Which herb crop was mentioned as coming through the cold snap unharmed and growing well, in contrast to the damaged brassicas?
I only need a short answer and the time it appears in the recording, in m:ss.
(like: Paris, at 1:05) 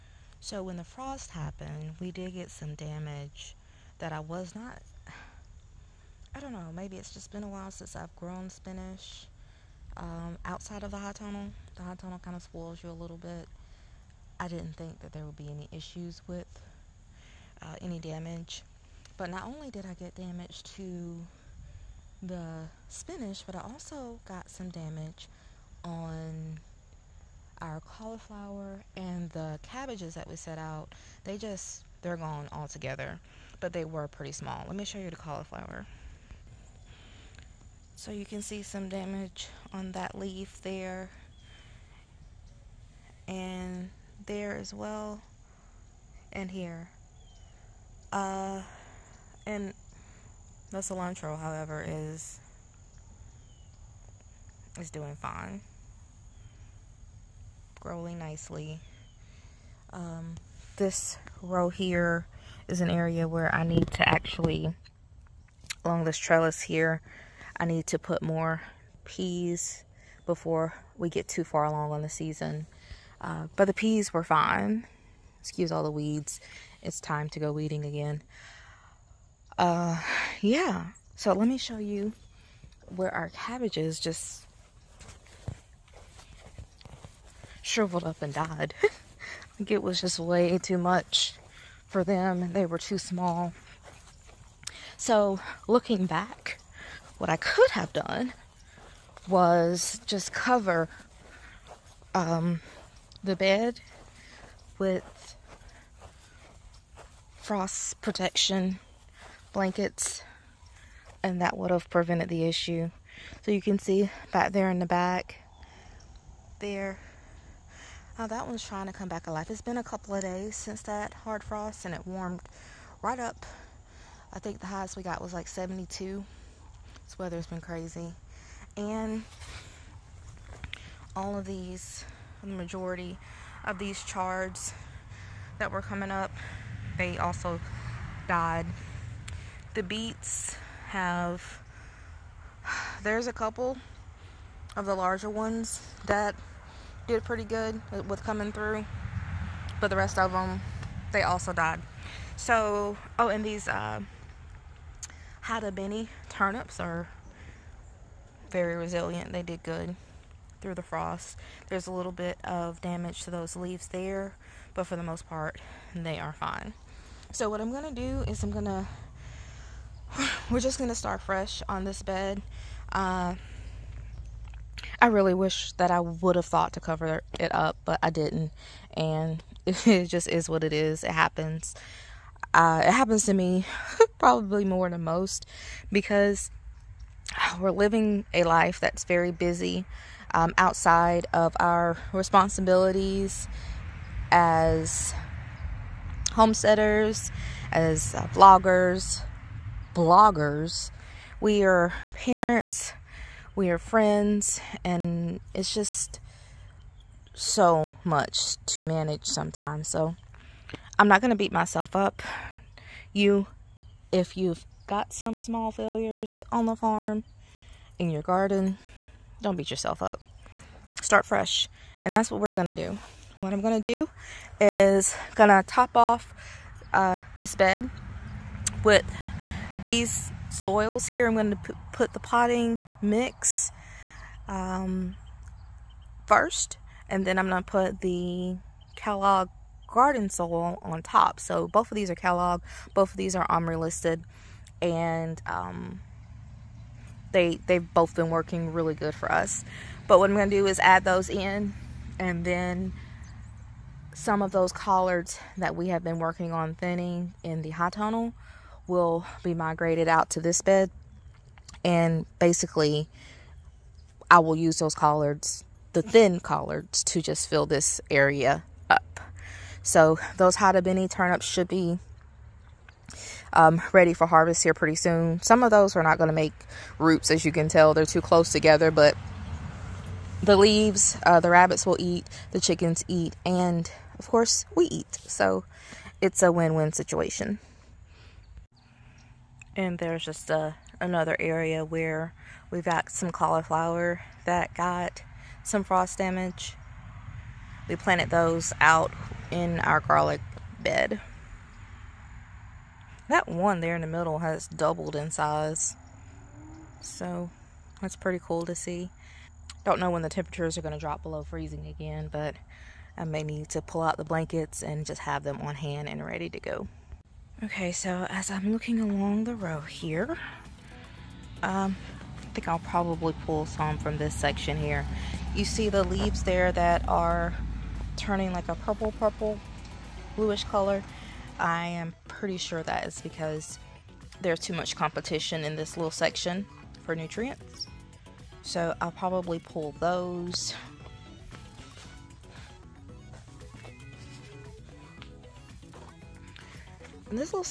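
Cilantro, at 0:50.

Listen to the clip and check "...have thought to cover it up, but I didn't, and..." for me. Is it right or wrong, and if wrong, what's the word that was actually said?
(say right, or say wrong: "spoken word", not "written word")
right.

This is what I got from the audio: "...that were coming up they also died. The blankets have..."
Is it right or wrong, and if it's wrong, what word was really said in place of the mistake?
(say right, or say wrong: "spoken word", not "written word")
wrong: "beets", not "blankets".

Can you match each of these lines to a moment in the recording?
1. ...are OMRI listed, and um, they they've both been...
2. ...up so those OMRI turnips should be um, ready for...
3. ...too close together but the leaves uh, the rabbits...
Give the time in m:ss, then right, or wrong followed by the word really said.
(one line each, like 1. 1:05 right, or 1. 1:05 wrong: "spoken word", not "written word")
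1. 4:03 right
2. 4:28 wrong: "Hatabini", not "OMRI"
3. 4:38 right.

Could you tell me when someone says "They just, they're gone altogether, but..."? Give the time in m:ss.
0:31.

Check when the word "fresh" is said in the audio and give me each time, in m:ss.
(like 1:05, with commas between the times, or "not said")
2:51, 3:41.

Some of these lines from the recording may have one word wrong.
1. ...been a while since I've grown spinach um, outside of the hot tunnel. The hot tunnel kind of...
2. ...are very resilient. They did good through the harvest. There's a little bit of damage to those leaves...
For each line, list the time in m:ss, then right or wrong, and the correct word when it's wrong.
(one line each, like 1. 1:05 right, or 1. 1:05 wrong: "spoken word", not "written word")
1. 0:07 right
2. 2:36 wrong: "frost", not "harvest".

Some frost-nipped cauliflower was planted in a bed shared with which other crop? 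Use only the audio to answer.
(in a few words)
Garlic.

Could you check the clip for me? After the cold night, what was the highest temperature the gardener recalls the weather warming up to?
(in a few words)
72.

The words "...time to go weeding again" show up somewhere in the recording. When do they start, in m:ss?
1:16.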